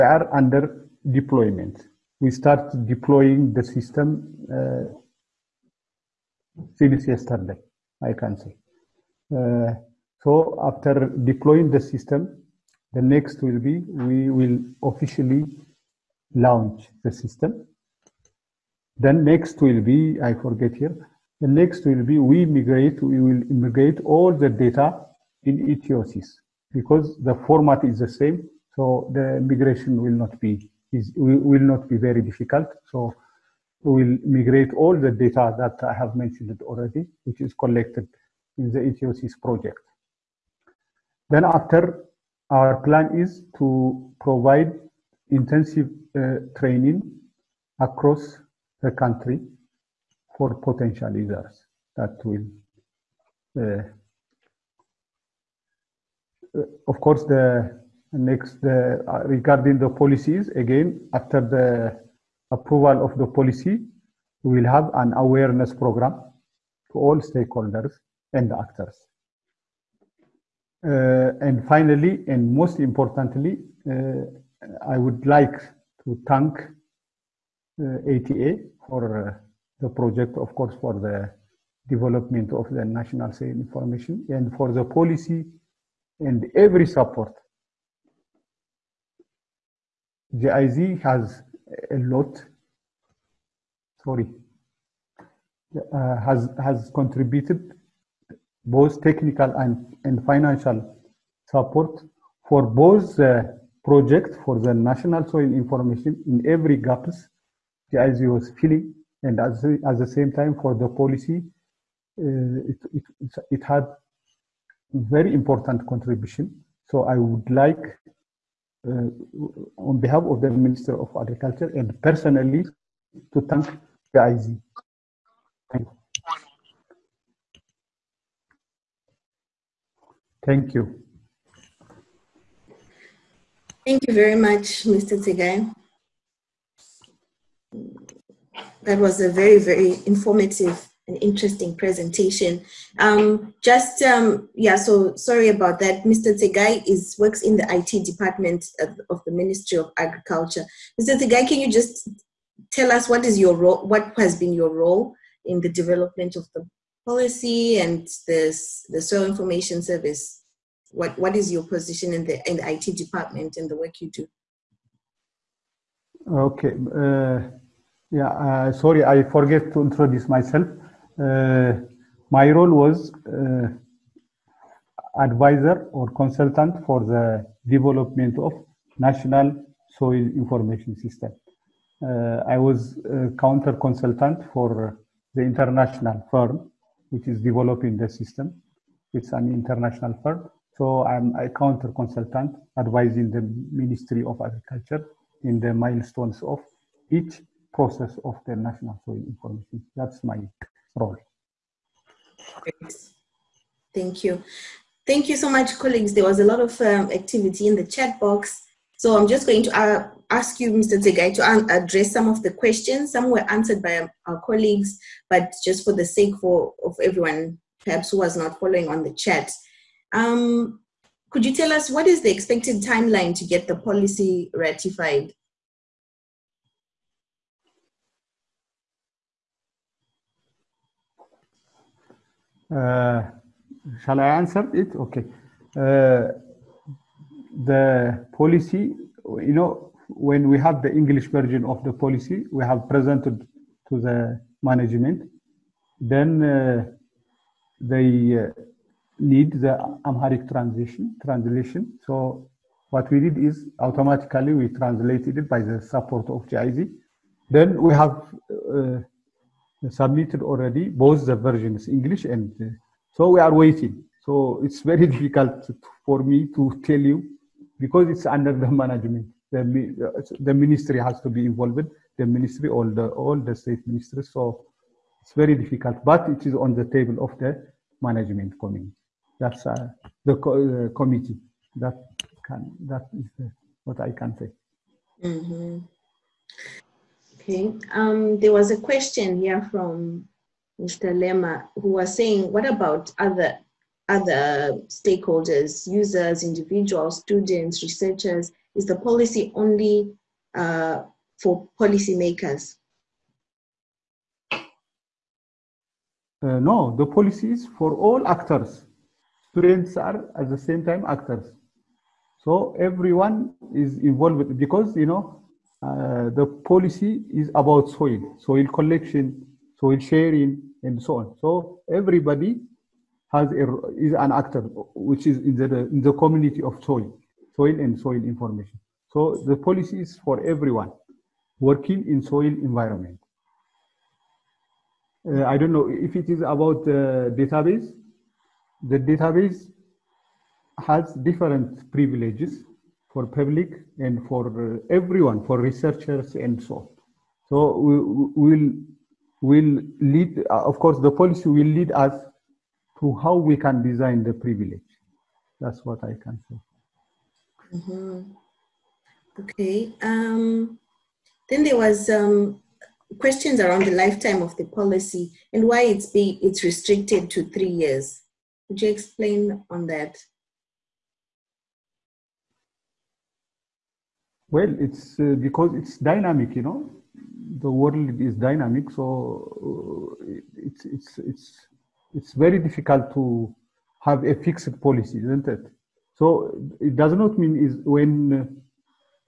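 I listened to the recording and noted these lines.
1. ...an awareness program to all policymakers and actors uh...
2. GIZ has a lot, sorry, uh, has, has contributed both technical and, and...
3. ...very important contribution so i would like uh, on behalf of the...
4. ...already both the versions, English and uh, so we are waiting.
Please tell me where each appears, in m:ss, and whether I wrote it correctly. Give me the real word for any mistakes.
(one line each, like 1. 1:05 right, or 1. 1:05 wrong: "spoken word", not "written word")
1. 1:04 wrong: "stakeholders", not "policymakers"
2. 1:30 right
3. 1:54 right
4. 4:20 right.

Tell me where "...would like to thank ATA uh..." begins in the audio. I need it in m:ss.
1:14.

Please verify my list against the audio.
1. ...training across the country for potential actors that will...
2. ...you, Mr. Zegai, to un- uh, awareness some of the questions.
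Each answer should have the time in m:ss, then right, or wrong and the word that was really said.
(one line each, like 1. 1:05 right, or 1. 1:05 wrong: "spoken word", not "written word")
1. 0:46 wrong: "users", not "actors"
2. 3:30 wrong: "address", not "awareness".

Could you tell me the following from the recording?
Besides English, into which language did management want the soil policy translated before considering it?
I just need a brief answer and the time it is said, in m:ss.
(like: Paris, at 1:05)
Amharic, at 4:10.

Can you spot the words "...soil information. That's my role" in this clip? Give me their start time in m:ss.
3:19.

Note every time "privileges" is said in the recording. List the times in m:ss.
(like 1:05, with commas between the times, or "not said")
5:41, 5:54.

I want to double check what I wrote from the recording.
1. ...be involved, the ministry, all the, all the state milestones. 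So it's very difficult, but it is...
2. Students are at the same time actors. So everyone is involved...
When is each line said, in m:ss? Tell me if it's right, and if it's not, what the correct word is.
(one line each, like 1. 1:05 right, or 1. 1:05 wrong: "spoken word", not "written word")
1. 4:31 wrong: "ministries", not "milestones"
2. 5:09 right.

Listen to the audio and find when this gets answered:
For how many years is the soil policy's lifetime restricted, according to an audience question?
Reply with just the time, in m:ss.
6:07.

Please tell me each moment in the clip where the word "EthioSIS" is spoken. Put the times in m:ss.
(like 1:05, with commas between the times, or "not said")
0:25, 0:38.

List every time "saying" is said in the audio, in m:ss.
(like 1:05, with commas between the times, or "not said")
4:52.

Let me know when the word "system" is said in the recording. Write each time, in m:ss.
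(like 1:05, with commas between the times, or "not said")
0:03, 0:11, 0:17, 3:00, 3:08.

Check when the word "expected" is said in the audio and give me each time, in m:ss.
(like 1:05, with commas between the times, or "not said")
3:42.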